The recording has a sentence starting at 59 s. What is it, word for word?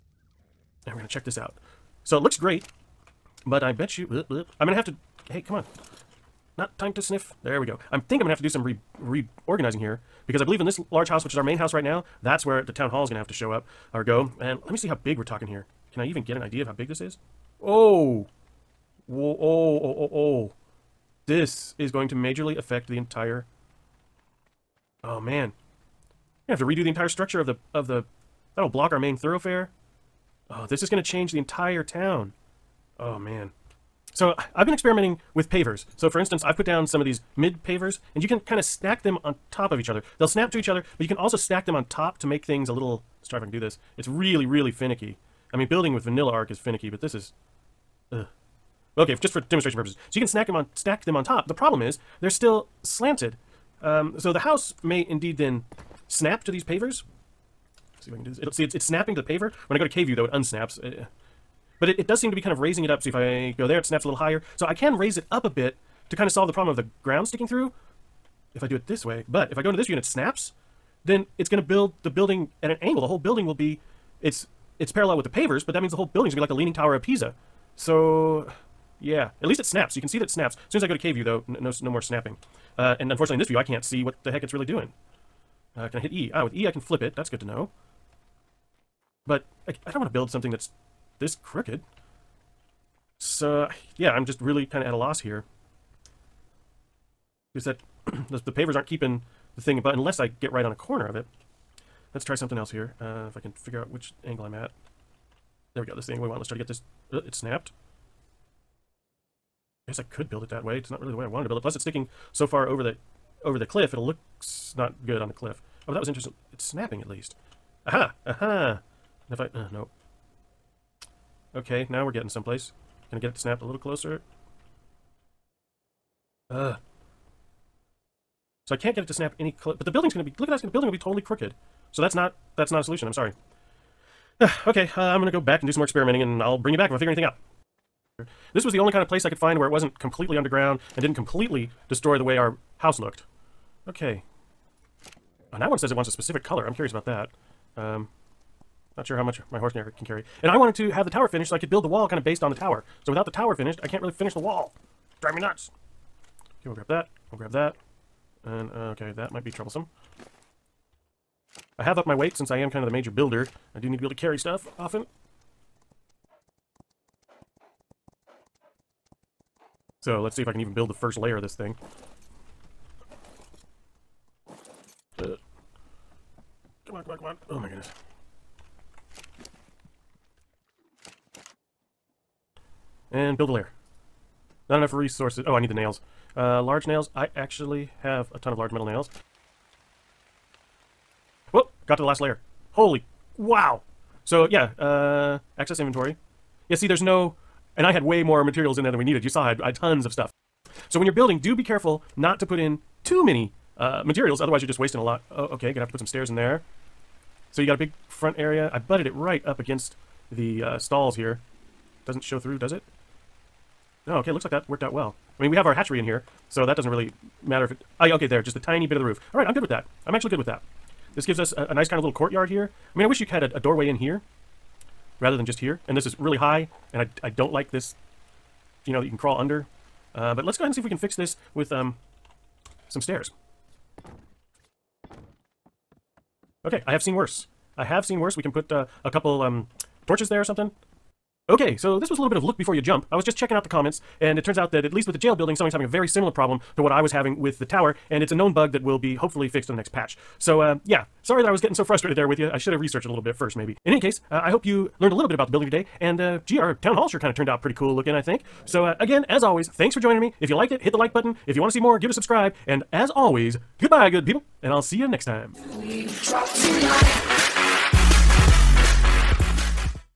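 When I go to K view though, it unsnaps.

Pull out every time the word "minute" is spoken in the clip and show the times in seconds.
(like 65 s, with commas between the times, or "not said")
not said.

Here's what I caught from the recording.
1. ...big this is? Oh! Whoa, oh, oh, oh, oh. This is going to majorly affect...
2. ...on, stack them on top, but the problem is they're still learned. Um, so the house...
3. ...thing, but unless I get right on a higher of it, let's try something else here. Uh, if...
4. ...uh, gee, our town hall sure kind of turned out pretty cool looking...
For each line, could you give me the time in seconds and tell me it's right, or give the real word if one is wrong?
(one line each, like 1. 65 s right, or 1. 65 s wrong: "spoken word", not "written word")
1. 16 s right
2. 50 s wrong: "slanted", not "learned"
3. 99 s wrong: "corner", not "higher"
4. 256 s right.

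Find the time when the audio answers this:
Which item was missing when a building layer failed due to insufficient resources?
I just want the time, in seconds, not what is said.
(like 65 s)
186 s.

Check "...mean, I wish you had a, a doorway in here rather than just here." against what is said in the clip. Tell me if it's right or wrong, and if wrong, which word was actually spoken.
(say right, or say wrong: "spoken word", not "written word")
right.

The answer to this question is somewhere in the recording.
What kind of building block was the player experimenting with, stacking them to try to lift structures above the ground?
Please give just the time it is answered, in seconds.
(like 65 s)
37 s.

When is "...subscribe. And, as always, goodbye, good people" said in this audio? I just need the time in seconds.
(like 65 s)
262 s.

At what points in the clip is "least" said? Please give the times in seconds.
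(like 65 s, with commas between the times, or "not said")
79 s, 117 s, 244 s.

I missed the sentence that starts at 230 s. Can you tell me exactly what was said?
Uh, but let's go ahead and see if we can fix this with um, some stairs.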